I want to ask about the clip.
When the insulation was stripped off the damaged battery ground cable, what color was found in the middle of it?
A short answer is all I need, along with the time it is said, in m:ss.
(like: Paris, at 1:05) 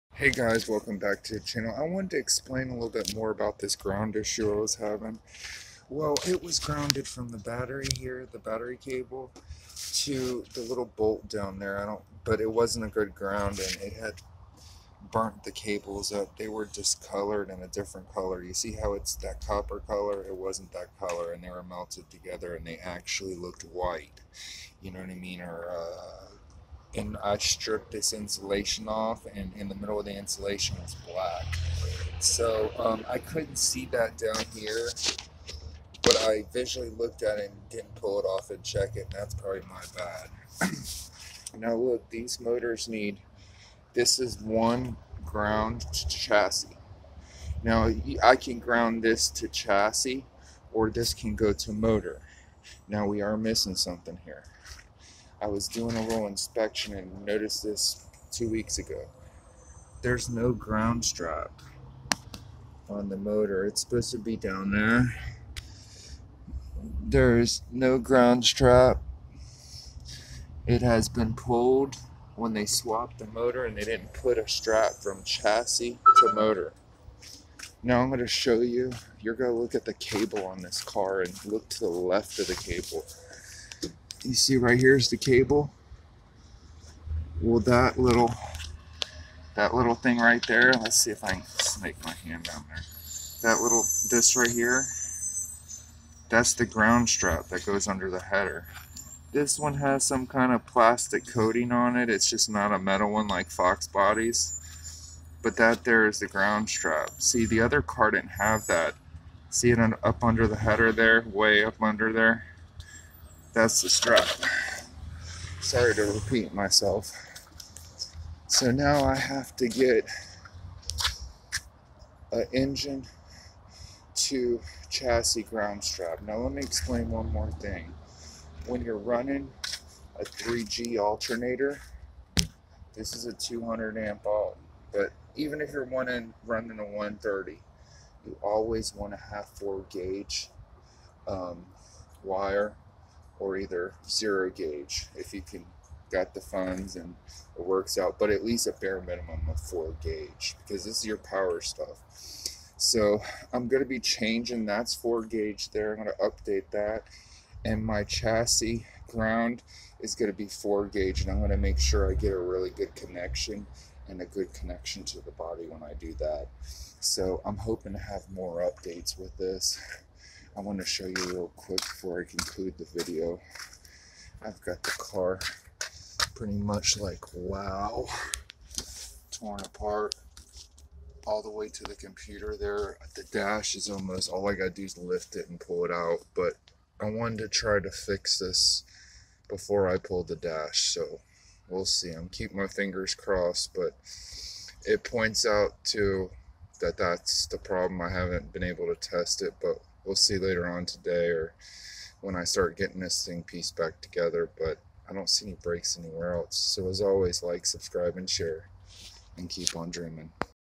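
Black, at 0:31.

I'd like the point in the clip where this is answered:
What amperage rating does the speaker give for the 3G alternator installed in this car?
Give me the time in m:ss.
2:13.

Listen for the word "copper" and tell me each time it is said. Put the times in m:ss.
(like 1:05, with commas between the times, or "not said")
0:19.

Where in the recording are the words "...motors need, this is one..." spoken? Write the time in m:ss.
0:42.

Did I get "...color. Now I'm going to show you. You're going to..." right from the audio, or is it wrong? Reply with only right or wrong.
wrong.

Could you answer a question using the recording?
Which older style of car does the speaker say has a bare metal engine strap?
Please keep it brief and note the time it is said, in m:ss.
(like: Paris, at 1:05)
Fox bodies, at 1:43.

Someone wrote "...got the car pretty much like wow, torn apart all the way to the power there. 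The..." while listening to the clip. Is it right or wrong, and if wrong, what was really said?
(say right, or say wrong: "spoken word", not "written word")
wrong: "computer", not "power".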